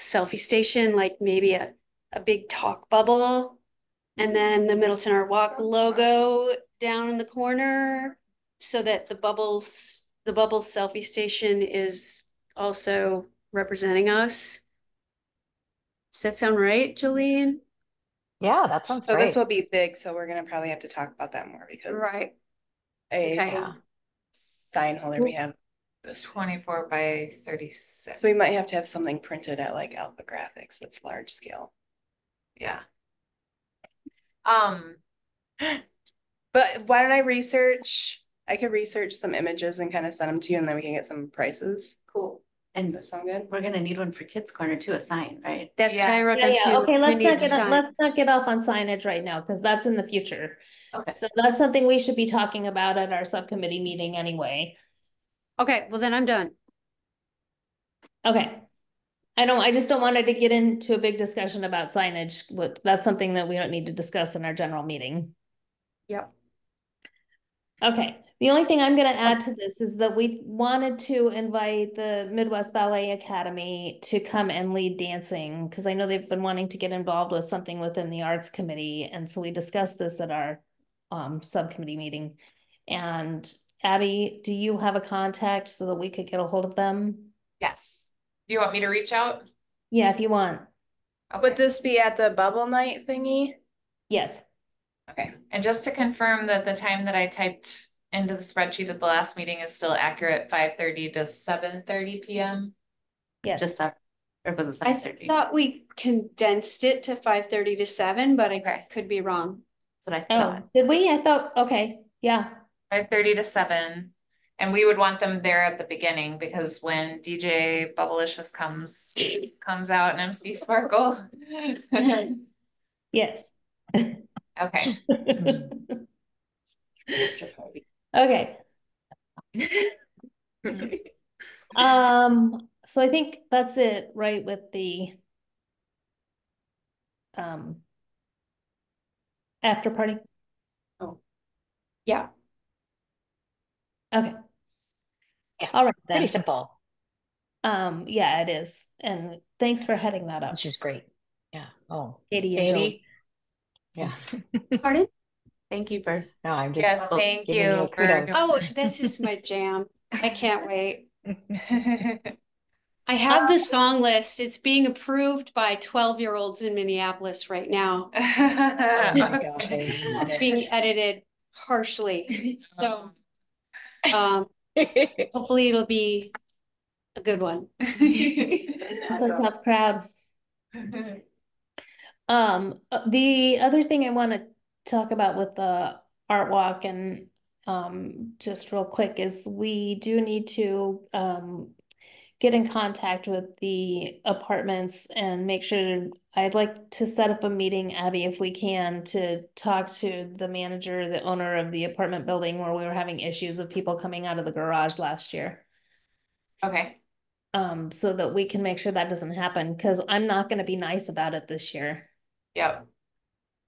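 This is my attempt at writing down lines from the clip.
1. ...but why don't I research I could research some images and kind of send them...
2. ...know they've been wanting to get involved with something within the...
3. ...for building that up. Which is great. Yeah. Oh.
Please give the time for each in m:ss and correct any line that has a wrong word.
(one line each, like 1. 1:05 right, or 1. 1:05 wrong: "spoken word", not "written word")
1. 0:36 right
2. 1:15 right
3. 2:29 wrong: "heading", not "building".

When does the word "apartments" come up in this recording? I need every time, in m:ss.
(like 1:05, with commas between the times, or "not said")
3:14, 3:21.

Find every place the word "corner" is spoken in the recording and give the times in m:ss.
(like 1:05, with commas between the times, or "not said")
0:07, 0:44.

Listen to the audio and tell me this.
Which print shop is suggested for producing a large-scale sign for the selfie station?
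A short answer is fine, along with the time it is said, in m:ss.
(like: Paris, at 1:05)
Alpha Graphics, at 0:29.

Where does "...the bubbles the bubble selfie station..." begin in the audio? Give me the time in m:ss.
0:09.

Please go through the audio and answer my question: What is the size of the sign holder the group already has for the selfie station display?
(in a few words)
24 by 36.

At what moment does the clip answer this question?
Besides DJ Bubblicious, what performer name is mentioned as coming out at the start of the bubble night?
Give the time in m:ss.
2:00.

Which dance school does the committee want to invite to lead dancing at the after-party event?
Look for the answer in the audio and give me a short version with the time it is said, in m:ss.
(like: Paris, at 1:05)
Midwest Ballet Academy, at 1:12.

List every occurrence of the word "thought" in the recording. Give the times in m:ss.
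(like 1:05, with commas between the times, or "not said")
1:45, 1:51.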